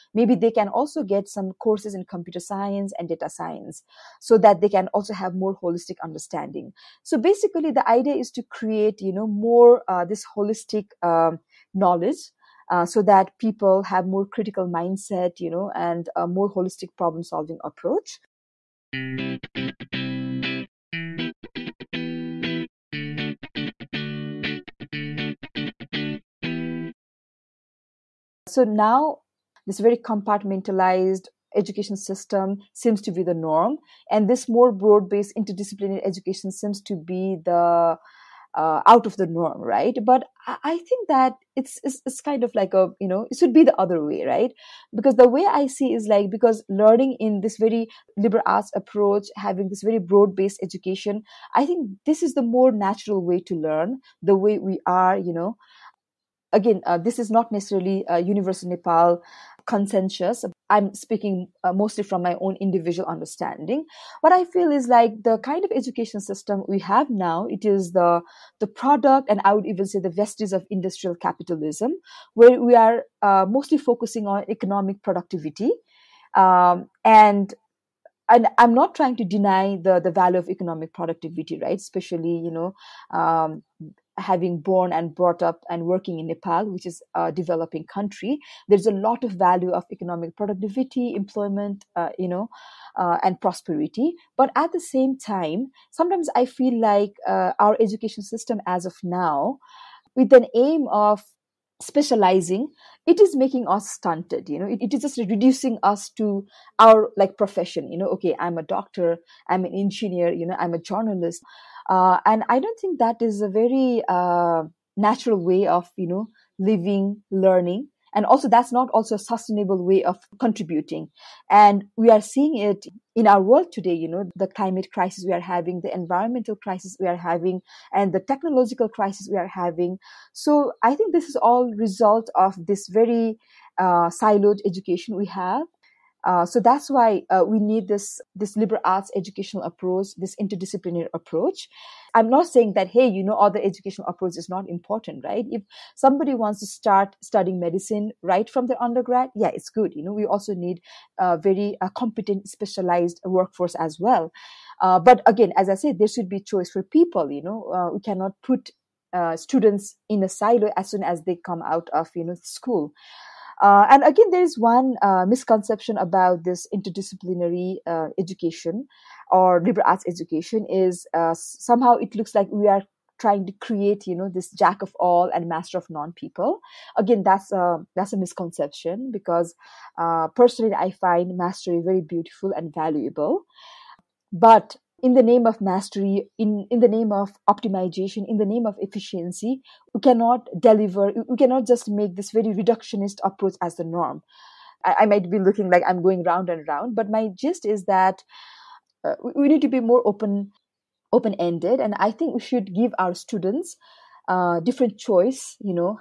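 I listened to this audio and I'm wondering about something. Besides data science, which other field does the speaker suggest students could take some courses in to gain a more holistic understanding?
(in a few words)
Computer science.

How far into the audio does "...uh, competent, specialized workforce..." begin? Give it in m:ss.
2:31.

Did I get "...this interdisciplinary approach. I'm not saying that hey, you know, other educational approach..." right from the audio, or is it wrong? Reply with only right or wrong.
right.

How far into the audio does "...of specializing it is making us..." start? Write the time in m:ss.
1:40.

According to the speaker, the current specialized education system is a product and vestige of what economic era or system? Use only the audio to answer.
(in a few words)
Industrial capitalism.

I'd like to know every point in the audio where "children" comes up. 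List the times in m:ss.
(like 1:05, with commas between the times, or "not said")
not said.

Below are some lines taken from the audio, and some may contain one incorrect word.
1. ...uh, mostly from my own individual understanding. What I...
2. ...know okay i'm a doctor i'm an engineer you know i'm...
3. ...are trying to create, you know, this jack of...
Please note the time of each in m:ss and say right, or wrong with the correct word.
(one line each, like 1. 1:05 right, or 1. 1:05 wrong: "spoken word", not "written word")
1. 1:01 right
2. 1:47 right
3. 2:52 right.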